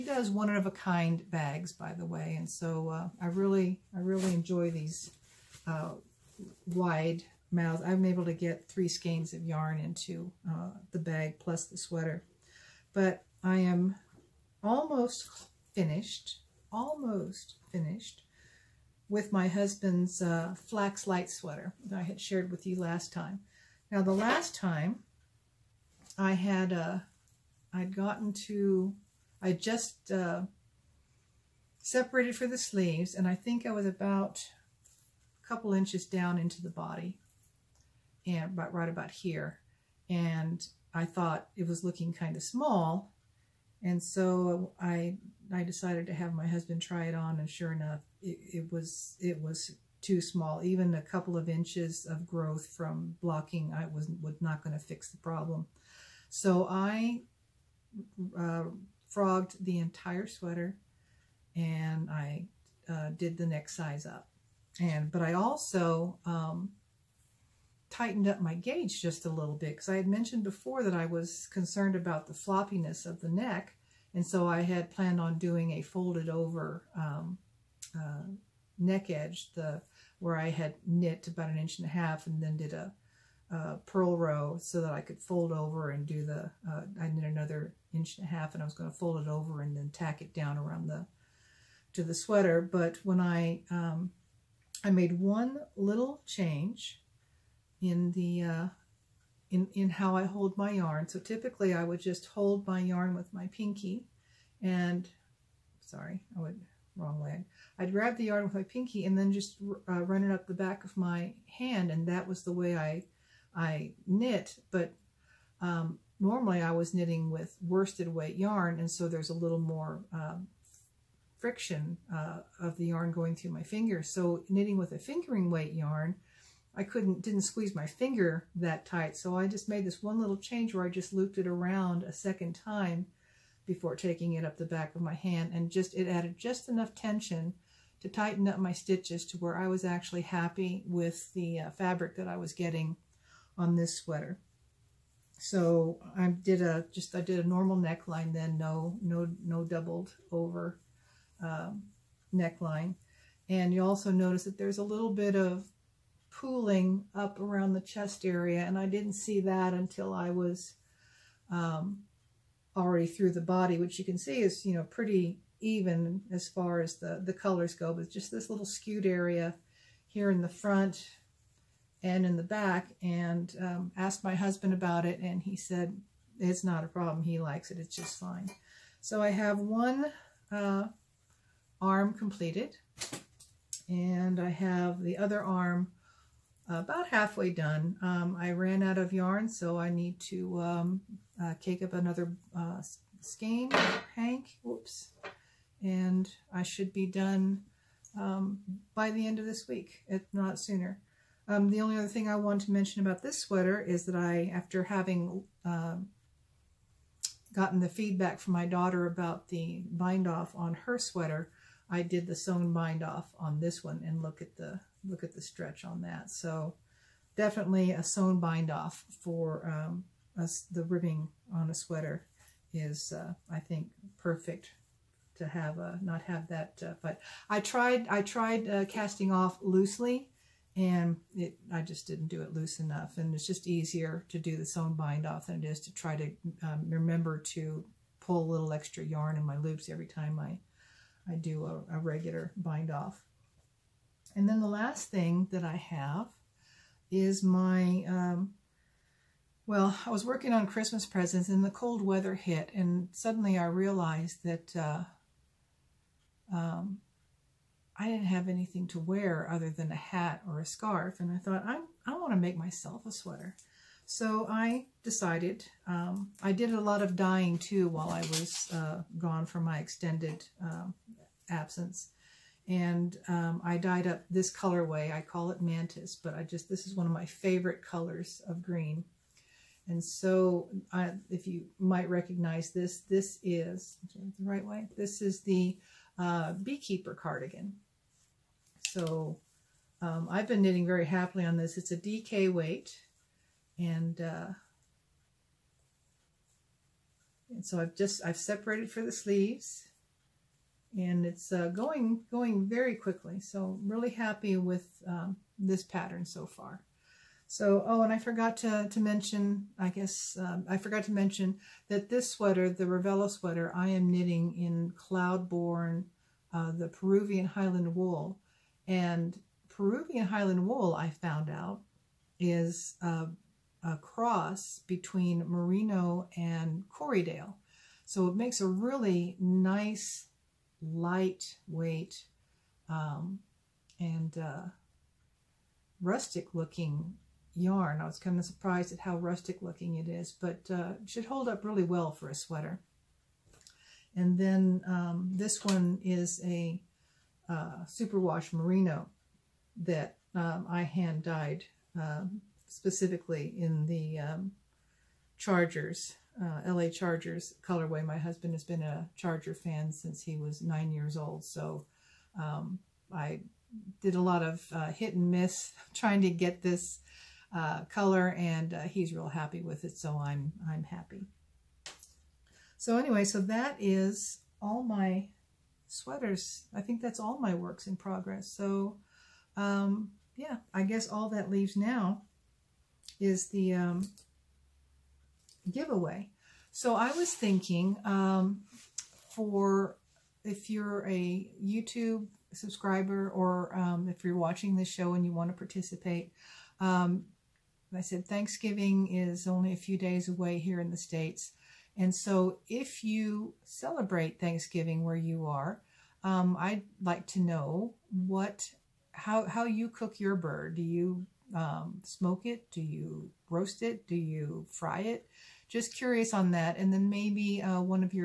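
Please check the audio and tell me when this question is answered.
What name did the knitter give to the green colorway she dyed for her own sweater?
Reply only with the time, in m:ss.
4:35.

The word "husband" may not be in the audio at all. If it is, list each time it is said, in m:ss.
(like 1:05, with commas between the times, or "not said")
0:19, 0:46, 2:54, 5:58.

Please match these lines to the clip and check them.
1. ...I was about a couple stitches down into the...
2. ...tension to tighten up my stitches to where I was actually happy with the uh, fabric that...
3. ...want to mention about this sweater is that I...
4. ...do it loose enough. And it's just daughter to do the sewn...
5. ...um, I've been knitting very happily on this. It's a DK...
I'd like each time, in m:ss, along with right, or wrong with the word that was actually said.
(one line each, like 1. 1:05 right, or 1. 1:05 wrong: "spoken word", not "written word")
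1. 0:33 wrong: "inches", not "stitches"
2. 2:16 right
3. 3:22 right
4. 3:52 wrong: "easier", not "daughter"
5. 4:50 right.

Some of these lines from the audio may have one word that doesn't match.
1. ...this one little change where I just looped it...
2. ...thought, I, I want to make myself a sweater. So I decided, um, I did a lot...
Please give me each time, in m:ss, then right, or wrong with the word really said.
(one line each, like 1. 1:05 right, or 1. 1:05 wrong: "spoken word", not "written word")
1. 2:09 right
2. 4:21 right.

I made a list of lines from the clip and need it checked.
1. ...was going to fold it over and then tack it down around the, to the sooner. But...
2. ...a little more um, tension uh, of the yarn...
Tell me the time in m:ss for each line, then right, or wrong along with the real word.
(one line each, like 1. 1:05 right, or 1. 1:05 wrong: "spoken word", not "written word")
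1. 1:28 wrong: "sweater", not "sooner"
2. 1:59 wrong: "friction", not "tension".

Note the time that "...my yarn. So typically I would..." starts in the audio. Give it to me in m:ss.
1:40.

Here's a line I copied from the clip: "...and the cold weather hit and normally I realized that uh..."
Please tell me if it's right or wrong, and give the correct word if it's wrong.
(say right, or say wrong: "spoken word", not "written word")
wrong: "suddenly", not "normally".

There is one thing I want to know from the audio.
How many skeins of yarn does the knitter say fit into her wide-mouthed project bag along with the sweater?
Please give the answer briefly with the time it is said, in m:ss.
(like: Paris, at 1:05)
3, at 0:08.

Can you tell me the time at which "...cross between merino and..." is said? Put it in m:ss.
5:23.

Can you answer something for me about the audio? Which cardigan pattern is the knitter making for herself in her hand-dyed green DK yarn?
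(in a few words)
Beekeeper cardigan.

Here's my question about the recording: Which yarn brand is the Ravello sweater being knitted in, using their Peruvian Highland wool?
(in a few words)
Cloudborn.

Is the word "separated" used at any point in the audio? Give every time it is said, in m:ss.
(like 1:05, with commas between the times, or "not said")
0:31, 4:58.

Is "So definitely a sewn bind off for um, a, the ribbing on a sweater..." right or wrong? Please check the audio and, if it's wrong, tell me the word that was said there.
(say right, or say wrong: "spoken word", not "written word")
right.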